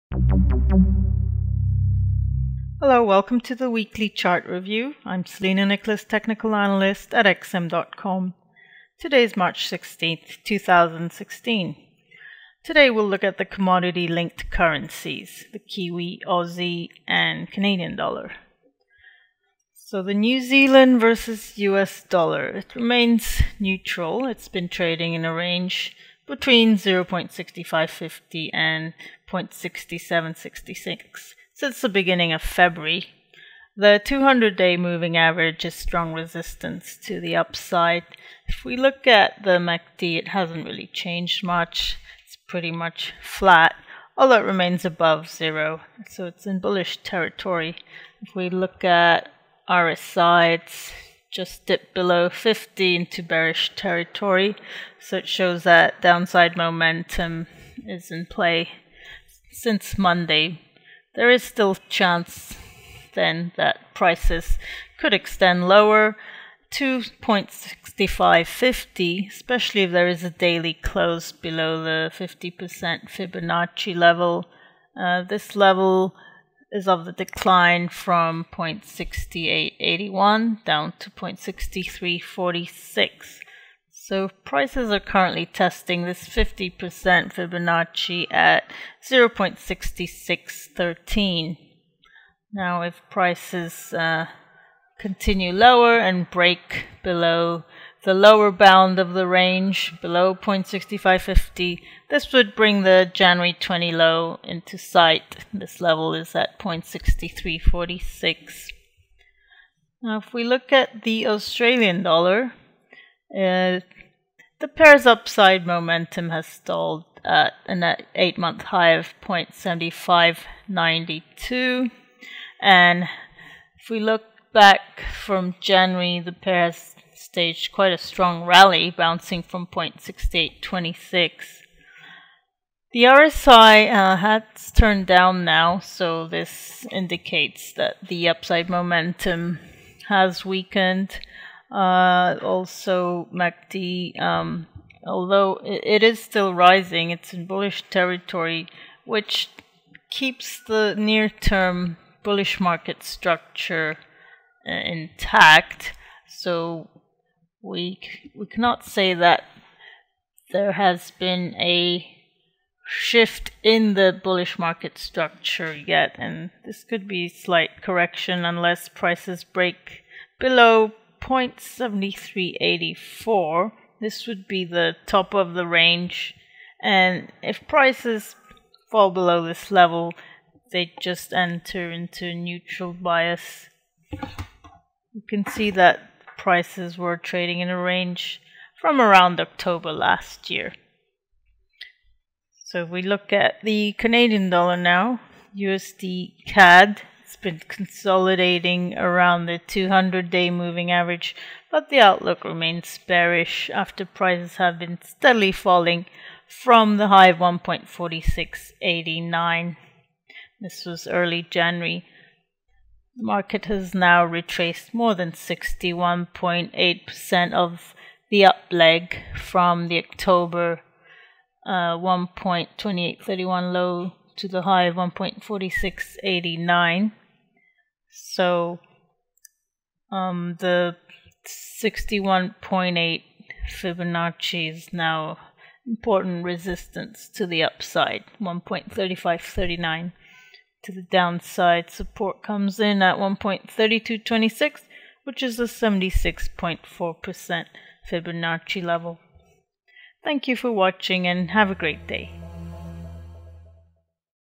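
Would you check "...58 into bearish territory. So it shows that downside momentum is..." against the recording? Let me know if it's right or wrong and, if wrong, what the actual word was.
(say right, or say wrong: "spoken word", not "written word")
wrong: "50", not "58".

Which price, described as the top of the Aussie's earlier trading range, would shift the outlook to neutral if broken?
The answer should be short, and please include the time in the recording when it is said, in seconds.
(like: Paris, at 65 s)
0.7384, at 171 s.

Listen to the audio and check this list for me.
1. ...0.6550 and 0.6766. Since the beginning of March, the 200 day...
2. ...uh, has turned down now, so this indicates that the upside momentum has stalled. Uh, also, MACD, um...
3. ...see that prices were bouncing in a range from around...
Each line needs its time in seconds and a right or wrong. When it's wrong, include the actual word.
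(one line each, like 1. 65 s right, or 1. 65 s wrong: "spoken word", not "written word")
1. 26 s wrong: "February", not "March"
2. 133 s wrong: "weakened", not "stalled"
3. 185 s wrong: "trading", not "bouncing".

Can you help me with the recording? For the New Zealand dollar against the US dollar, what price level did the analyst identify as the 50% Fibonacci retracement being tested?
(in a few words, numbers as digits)
0.6613.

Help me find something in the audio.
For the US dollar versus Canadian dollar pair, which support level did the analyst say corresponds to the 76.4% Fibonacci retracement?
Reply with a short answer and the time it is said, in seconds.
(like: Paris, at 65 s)
1.3226, at 243 s.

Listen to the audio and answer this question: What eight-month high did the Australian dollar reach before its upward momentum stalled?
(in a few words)
0.7592.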